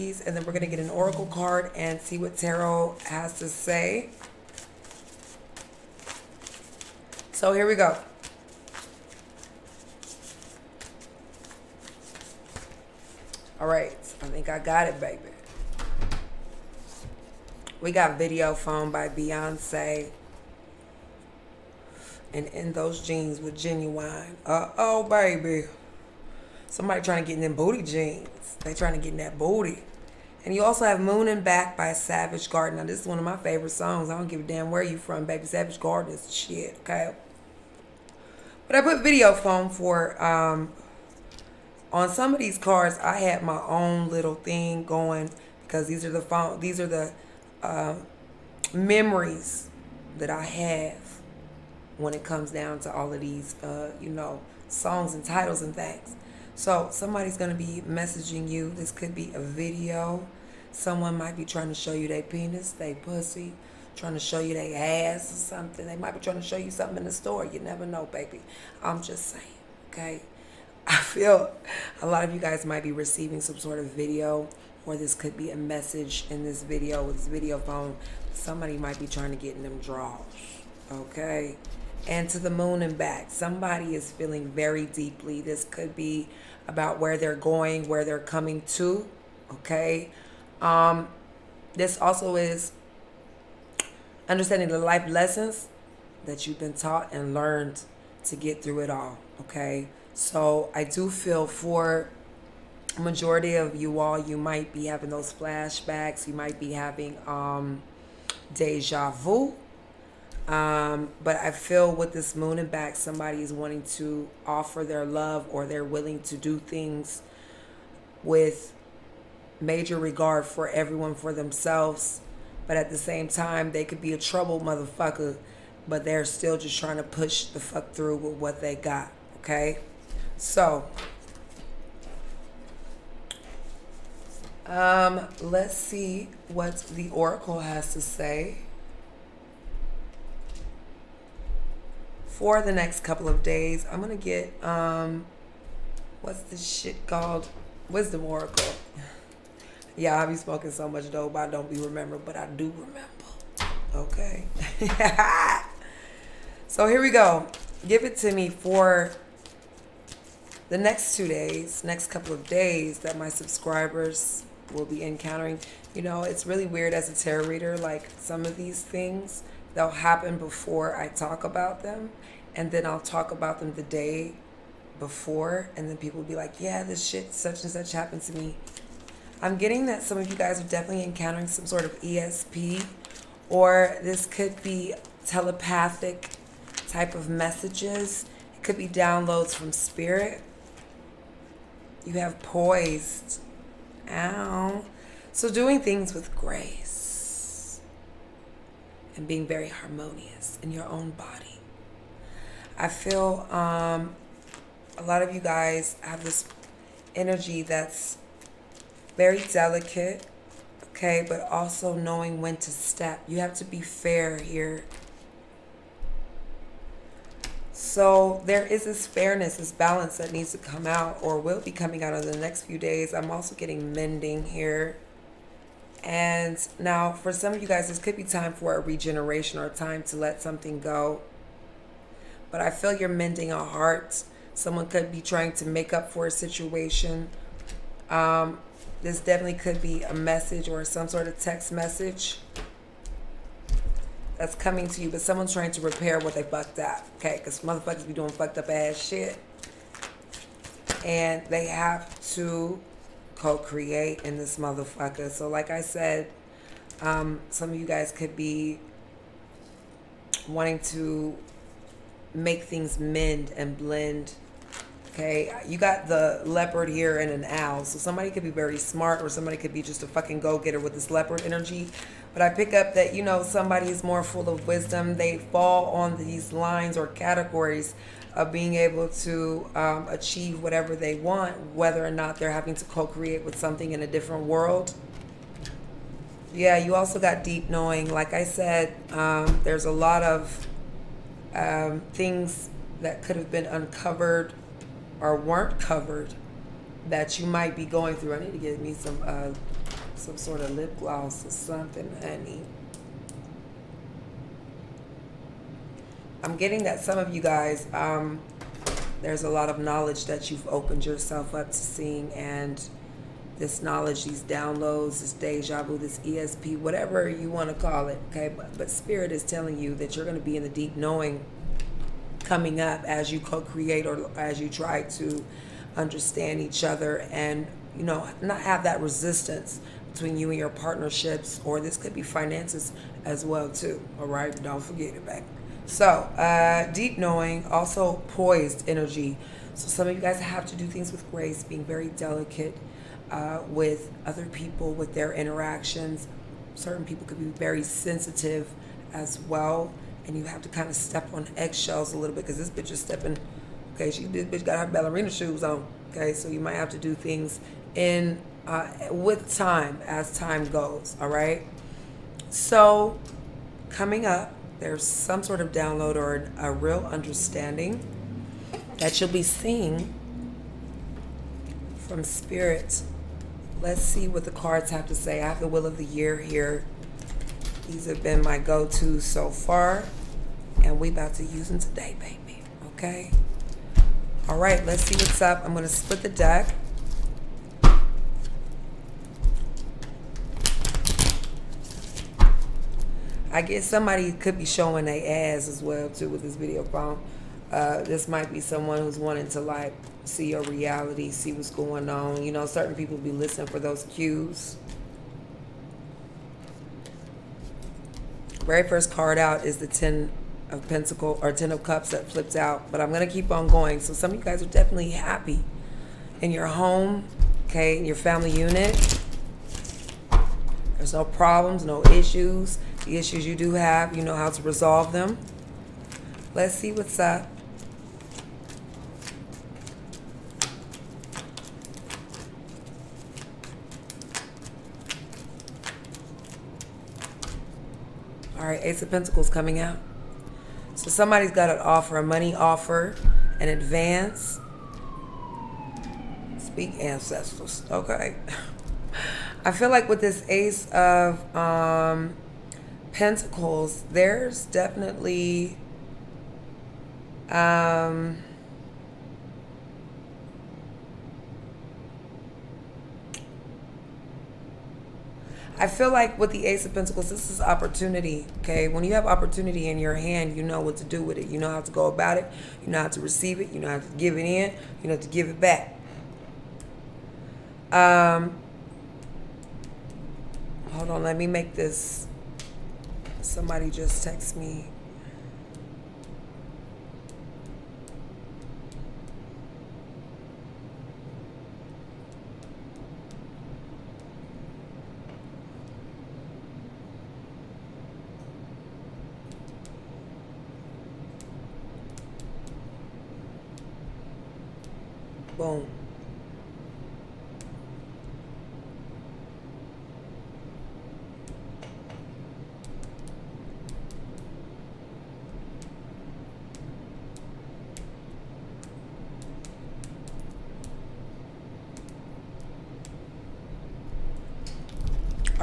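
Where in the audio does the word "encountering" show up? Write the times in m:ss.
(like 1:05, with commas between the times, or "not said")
2:45, 3:01.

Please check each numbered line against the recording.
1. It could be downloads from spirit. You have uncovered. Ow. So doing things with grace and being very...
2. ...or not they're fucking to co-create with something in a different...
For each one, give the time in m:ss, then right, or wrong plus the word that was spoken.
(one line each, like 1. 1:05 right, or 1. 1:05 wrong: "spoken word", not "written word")
1. 3:08 wrong: "poised", not "uncovered"
2. 4:42 wrong: "having", not "fucking".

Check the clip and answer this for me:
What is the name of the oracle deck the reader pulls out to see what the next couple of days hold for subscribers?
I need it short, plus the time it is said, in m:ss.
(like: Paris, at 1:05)
Wisdom Oracle, at 2:27.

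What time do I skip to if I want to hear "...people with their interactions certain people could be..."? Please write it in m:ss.
5:44.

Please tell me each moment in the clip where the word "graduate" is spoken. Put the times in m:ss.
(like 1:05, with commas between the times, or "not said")
not said.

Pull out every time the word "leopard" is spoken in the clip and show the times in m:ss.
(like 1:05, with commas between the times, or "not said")
4:26, 4:31.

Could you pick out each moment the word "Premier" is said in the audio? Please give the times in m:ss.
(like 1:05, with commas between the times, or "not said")
not said.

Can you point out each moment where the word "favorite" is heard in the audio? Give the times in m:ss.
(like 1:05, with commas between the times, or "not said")
0:33.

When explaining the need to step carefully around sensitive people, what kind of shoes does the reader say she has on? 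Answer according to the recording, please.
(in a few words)
Ballerina shoes.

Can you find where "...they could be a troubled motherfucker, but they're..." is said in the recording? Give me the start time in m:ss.
2:03.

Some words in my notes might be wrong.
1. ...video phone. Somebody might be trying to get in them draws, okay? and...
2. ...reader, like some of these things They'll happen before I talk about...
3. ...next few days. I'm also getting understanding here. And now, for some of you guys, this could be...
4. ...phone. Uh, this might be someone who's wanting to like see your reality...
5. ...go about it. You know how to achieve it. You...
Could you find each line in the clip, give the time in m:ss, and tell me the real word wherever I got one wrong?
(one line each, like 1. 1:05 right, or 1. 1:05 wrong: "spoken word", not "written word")
1. 1:17 right
2. 2:47 right
3. 3:42 wrong: "mending", not "understanding"
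4. 6:36 right
5. 7:51 wrong: "receive", not "achieve".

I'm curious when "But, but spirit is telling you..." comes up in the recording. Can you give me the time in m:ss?
5:18.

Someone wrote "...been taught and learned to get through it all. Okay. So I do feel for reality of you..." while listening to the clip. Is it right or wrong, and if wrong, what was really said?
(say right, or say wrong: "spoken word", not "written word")
wrong: "majority", not "reality".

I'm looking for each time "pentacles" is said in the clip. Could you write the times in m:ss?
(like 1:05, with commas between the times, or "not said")
6:50, 7:19, 7:33, 7:46.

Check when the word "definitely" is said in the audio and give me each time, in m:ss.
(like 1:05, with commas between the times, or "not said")
3:00, 3:59, 6:54, 7:34.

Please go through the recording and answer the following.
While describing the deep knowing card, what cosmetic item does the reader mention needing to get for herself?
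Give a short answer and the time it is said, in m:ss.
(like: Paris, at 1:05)
Lip gloss, at 5:00.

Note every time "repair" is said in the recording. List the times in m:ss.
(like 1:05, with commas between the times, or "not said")
4:05.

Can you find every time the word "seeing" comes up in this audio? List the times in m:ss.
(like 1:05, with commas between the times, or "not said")
5:11, 6:09.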